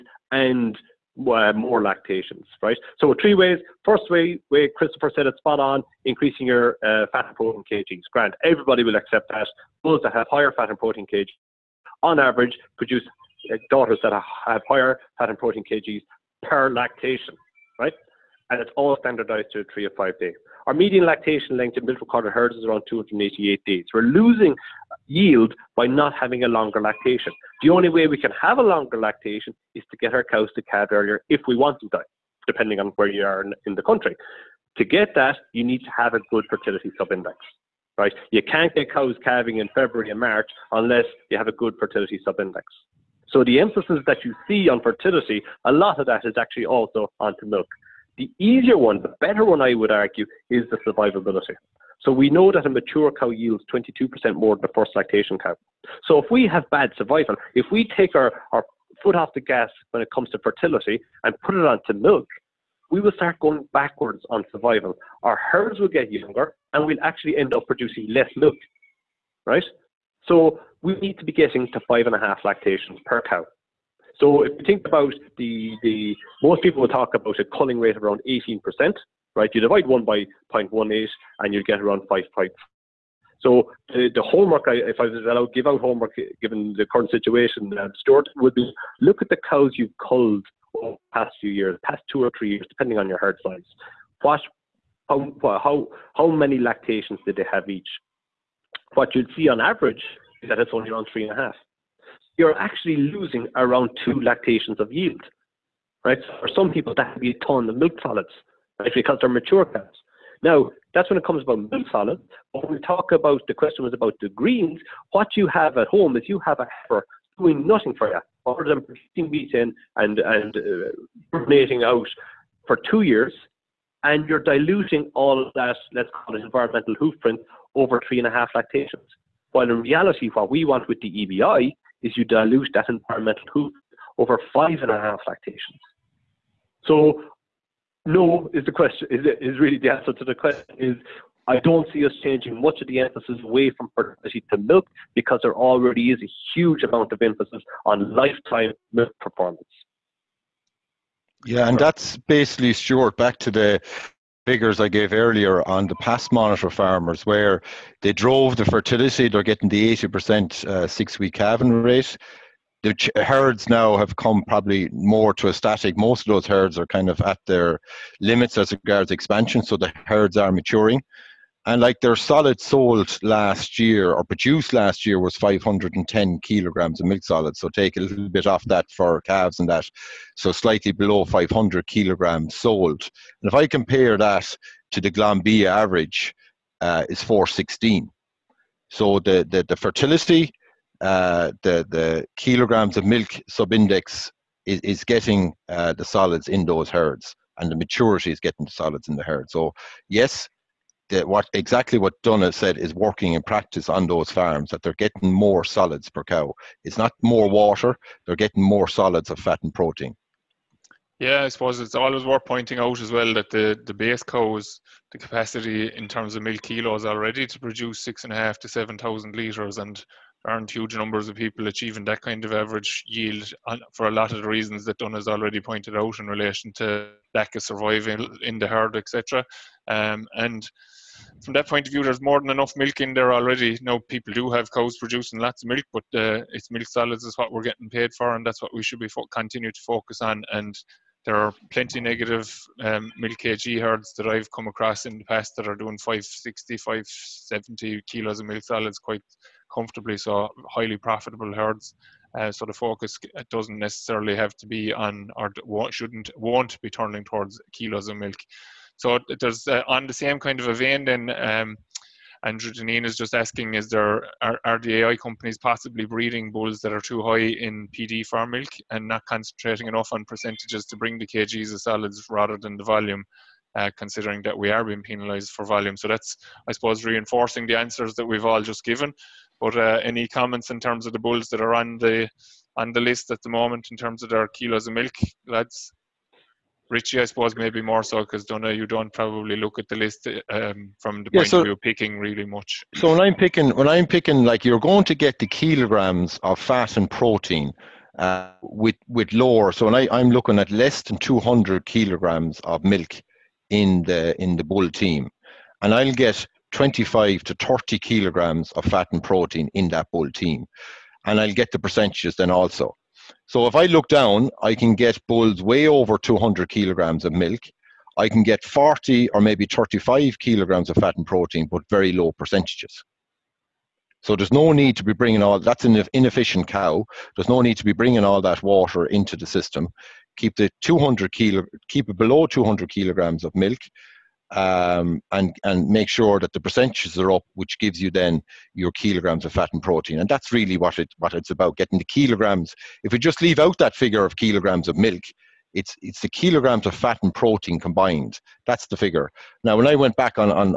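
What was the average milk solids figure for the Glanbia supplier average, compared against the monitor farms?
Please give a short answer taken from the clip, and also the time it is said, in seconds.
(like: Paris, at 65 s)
416, at 187 s.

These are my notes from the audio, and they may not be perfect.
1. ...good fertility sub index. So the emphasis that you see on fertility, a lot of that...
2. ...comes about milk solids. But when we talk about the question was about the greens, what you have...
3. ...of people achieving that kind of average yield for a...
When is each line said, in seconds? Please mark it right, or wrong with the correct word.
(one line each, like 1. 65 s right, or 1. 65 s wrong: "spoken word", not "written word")
1. 41 s right
2. 111 s right
3. 221 s right.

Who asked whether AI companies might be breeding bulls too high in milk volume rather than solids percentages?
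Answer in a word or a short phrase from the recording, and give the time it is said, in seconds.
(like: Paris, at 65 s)
Andrew Deneen, at 262 s.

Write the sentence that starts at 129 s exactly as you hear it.
While in reality, what we want with the EBI is you dilute that environmental hoop over five and a half lactations.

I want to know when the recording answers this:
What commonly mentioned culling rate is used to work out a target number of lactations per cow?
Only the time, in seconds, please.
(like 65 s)
78 s.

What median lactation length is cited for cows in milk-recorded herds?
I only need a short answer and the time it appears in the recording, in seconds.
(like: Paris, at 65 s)
288 days, at 22 s.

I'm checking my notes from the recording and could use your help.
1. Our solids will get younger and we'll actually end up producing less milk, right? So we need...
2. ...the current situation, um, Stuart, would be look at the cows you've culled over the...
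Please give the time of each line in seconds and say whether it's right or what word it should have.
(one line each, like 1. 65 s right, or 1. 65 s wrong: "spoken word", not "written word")
1. 65 s wrong: "herds", not "solids"
2. 86 s right.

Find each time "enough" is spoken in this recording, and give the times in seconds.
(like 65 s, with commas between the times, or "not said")
232 s, 269 s.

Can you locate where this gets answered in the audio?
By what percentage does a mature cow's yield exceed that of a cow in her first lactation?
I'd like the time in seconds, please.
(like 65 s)
53 s.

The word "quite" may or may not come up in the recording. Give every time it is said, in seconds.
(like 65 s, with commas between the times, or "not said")
248 s.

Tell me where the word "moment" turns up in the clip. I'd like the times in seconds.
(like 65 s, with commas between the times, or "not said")
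283 s.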